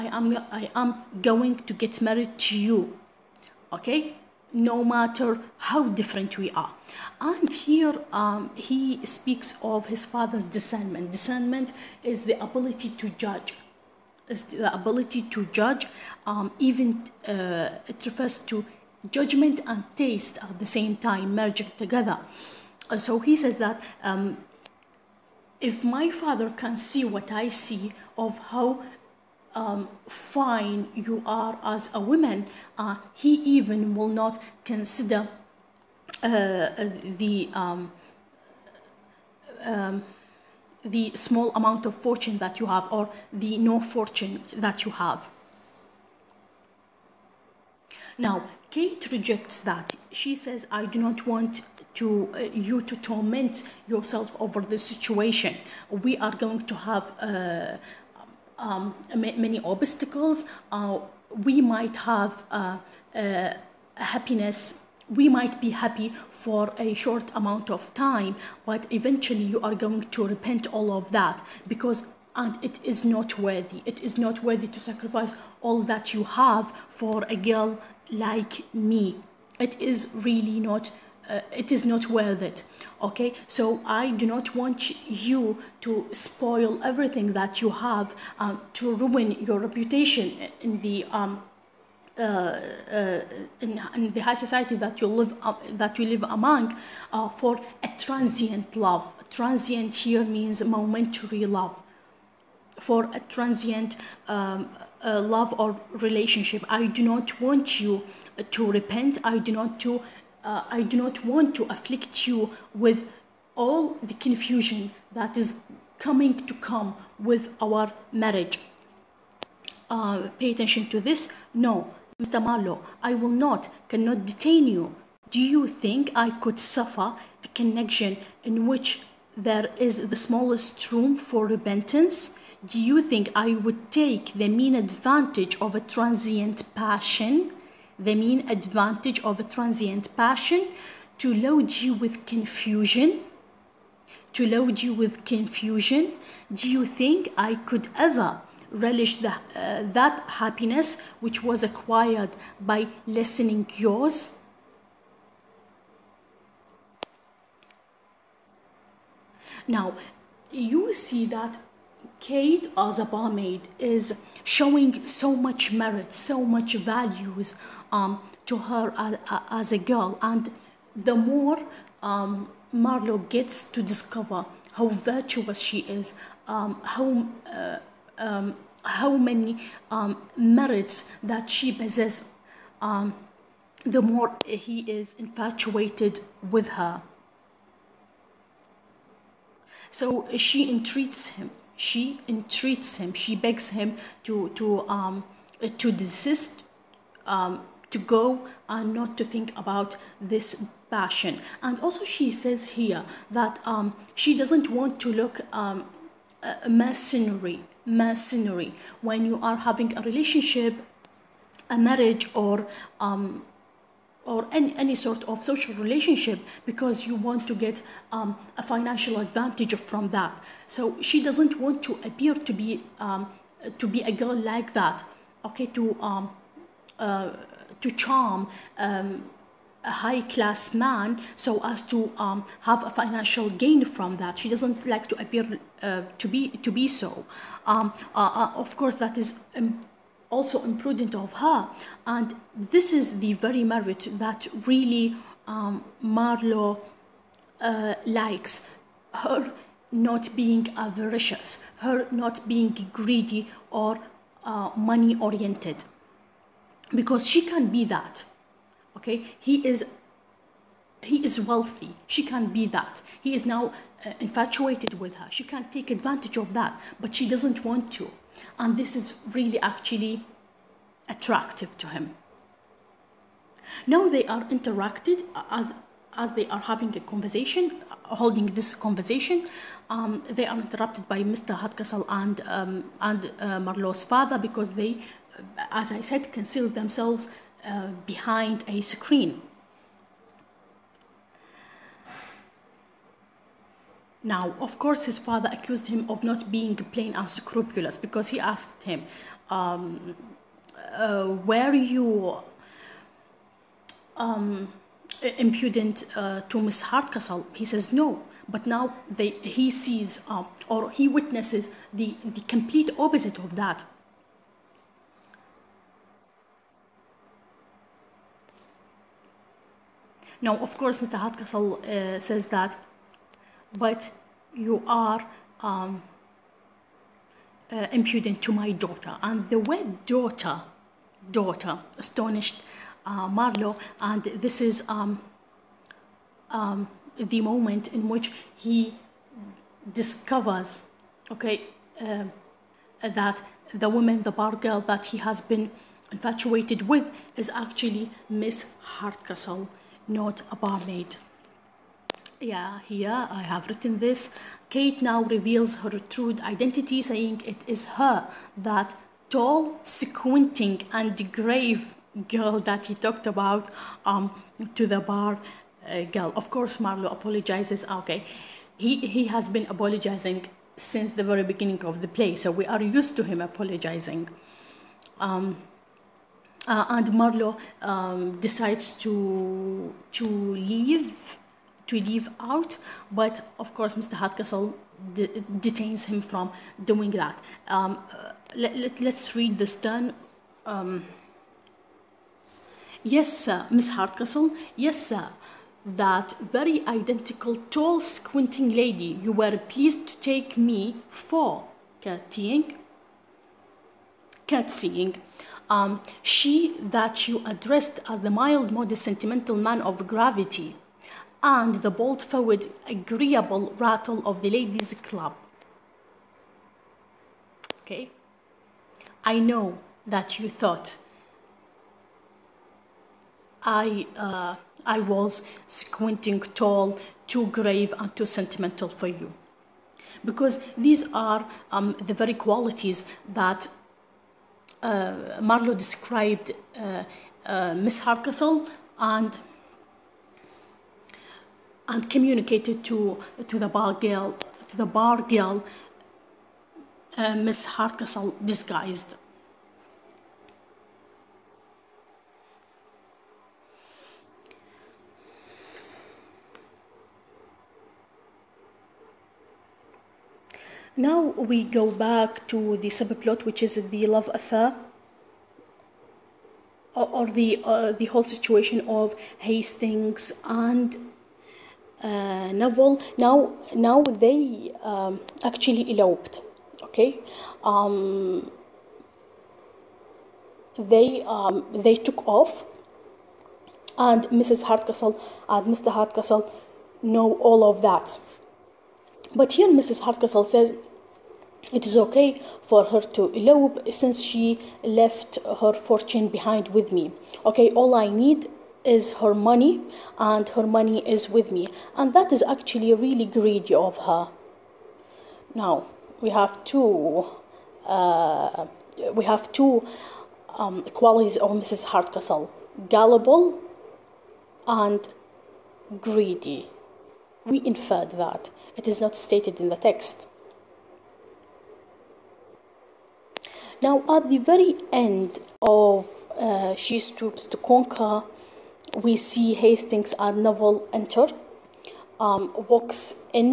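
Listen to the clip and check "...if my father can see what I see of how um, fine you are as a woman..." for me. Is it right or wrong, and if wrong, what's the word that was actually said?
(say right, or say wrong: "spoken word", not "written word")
right.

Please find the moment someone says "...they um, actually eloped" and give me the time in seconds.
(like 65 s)
474 s.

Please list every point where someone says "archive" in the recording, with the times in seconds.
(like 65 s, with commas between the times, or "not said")
not said.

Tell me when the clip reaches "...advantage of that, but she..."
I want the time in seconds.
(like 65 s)
265 s.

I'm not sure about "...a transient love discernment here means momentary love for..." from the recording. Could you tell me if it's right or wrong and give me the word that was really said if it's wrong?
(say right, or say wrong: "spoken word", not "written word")
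wrong: "transient", not "discernment".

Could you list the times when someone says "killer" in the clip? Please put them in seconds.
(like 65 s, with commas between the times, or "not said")
not said.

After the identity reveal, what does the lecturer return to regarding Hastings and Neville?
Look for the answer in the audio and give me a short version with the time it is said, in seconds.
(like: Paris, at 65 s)
the subplot, at 462 s.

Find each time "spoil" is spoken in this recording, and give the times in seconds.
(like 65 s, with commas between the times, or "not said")
86 s.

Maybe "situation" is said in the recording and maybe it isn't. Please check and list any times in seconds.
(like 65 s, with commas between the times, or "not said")
54 s, 468 s.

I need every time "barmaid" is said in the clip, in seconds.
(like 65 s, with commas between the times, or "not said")
163 s, 350 s.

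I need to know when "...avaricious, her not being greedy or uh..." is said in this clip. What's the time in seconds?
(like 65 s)
250 s.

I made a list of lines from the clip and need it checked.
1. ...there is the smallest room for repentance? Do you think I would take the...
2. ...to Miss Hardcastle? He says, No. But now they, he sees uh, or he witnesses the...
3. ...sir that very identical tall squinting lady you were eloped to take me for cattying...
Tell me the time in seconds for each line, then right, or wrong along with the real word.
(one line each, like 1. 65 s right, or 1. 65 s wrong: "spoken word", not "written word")
1. 129 s right
2. 306 s right
3. 395 s wrong: "pleased", not "eloped".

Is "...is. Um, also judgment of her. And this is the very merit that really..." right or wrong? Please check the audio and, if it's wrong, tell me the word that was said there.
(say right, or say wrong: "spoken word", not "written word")
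wrong: "imprudent", not "judgment".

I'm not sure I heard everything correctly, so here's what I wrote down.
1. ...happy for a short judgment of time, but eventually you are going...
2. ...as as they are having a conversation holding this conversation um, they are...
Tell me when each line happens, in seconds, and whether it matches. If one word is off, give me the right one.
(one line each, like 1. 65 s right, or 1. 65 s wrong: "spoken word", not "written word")
1. 65 s wrong: "amount", not "judgment"
2. 275 s right.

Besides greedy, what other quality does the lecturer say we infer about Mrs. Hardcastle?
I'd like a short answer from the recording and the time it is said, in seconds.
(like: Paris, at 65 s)
gullible, at 512 s.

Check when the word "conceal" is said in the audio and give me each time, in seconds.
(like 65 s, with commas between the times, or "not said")
286 s.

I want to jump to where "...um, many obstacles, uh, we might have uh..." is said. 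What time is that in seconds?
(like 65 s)
58 s.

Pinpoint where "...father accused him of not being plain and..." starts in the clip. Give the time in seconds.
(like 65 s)
295 s.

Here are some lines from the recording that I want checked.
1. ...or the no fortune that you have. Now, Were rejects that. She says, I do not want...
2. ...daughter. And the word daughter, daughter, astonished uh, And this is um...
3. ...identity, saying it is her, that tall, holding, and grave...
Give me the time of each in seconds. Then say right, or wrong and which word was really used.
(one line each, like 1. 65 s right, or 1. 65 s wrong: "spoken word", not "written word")
1. 42 s wrong: "Kate", not "Were"
2. 328 s right
3. 356 s wrong: "squinting", not "holding".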